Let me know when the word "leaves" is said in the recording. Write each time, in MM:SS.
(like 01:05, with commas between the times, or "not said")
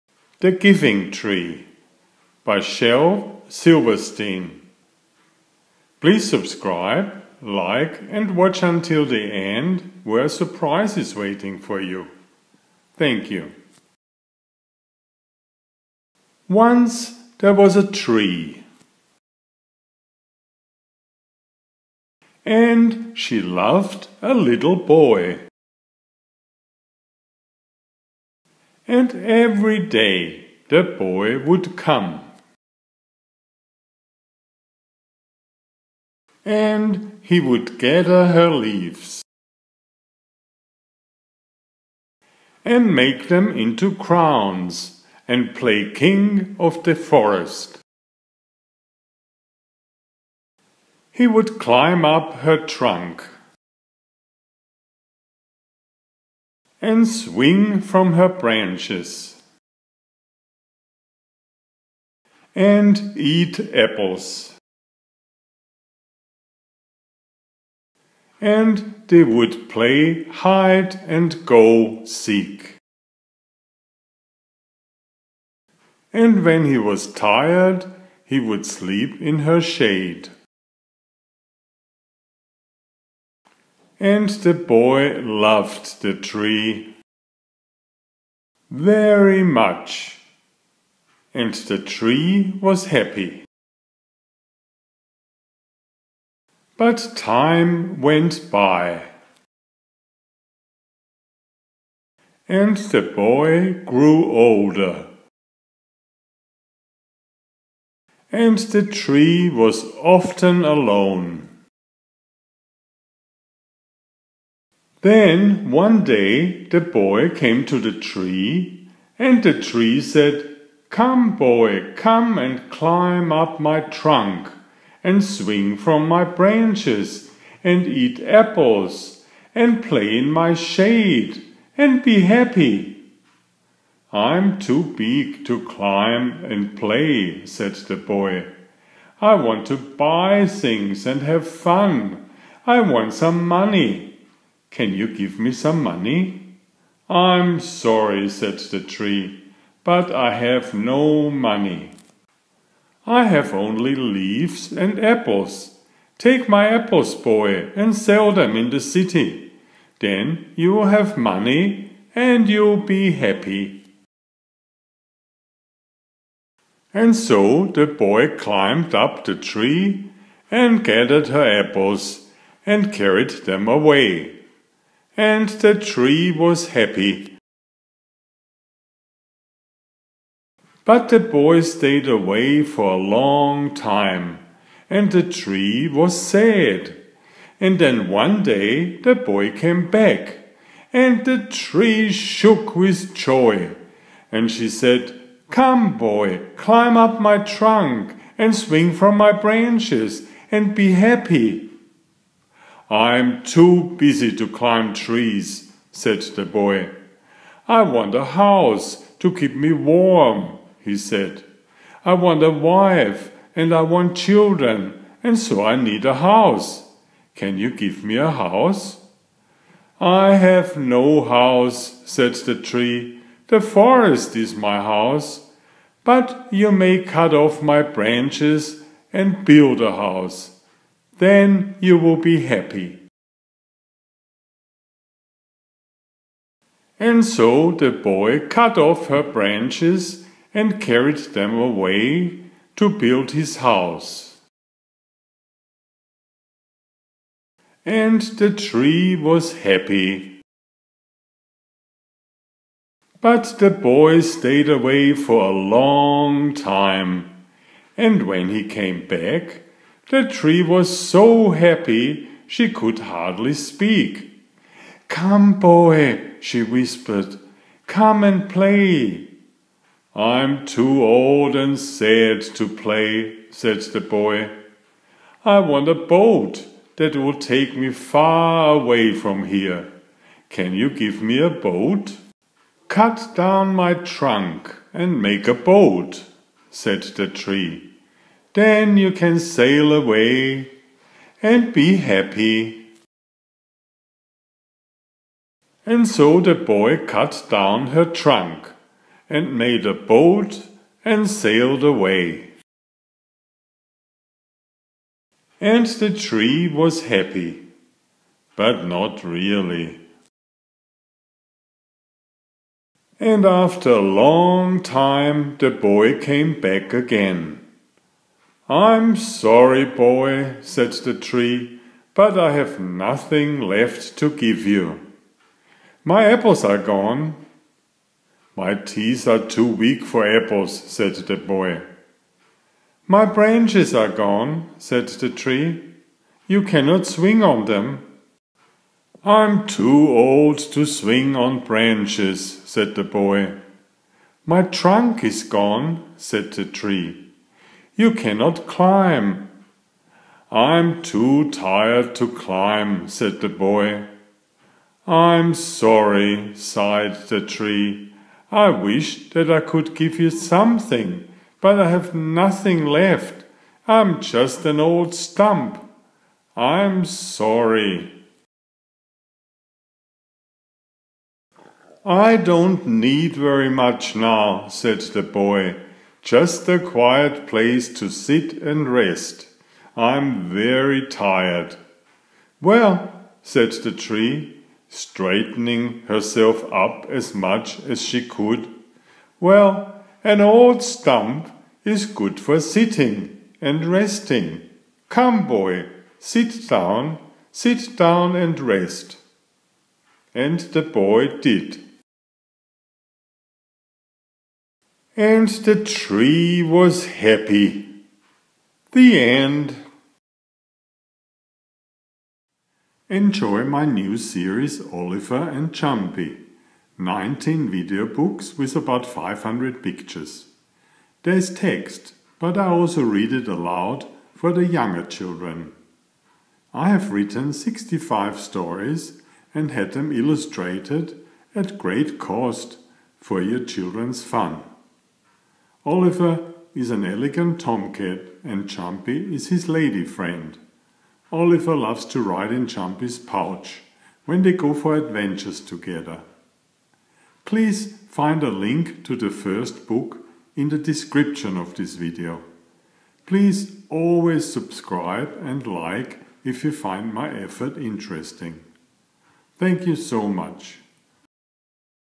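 00:38, 02:33.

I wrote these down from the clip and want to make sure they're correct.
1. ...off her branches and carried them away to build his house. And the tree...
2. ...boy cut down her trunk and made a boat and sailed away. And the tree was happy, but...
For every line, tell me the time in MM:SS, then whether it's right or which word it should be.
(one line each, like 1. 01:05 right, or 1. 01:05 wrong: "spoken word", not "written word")
1. 03:58 right
2. 04:56 right.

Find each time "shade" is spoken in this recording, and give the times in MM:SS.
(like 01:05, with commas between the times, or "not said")
01:19, 02:10.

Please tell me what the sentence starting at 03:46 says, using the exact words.
But you may cut off my branches and build a house then you will be happy.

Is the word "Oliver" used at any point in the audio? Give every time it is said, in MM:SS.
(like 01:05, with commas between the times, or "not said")
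06:54, 07:15, 07:21.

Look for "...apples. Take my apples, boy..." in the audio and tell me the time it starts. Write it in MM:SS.
02:35.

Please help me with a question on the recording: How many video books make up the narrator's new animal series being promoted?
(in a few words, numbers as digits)
19.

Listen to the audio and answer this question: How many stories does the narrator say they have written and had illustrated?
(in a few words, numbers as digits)
65.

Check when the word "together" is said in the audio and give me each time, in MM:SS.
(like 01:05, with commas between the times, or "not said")
07:25.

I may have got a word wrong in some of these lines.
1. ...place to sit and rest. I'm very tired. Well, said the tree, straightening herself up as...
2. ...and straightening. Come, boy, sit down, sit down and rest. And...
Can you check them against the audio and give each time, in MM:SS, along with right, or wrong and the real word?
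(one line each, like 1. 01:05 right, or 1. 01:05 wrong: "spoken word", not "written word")
1. 06:17 right
2. 06:33 wrong: "resting", not "straightening".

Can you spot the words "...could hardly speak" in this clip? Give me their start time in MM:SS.
04:22.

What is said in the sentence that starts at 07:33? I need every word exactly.
Please always subscribe and like if you find my effort interesting.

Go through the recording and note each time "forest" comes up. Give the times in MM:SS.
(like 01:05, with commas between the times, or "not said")
00:46, 03:43.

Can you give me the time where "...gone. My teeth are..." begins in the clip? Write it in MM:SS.
05:26.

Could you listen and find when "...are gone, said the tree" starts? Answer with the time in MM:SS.
05:33.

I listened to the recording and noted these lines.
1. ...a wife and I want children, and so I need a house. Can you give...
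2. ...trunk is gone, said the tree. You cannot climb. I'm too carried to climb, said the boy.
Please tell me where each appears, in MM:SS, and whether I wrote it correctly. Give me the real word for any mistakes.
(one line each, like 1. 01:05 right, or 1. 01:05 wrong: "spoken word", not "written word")
1. 03:32 right
2. 05:44 wrong: "tired", not "carried".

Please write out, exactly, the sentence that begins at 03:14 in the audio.
And she said, Come, boy, climb up my trunk, and swing from my branches, and be happy.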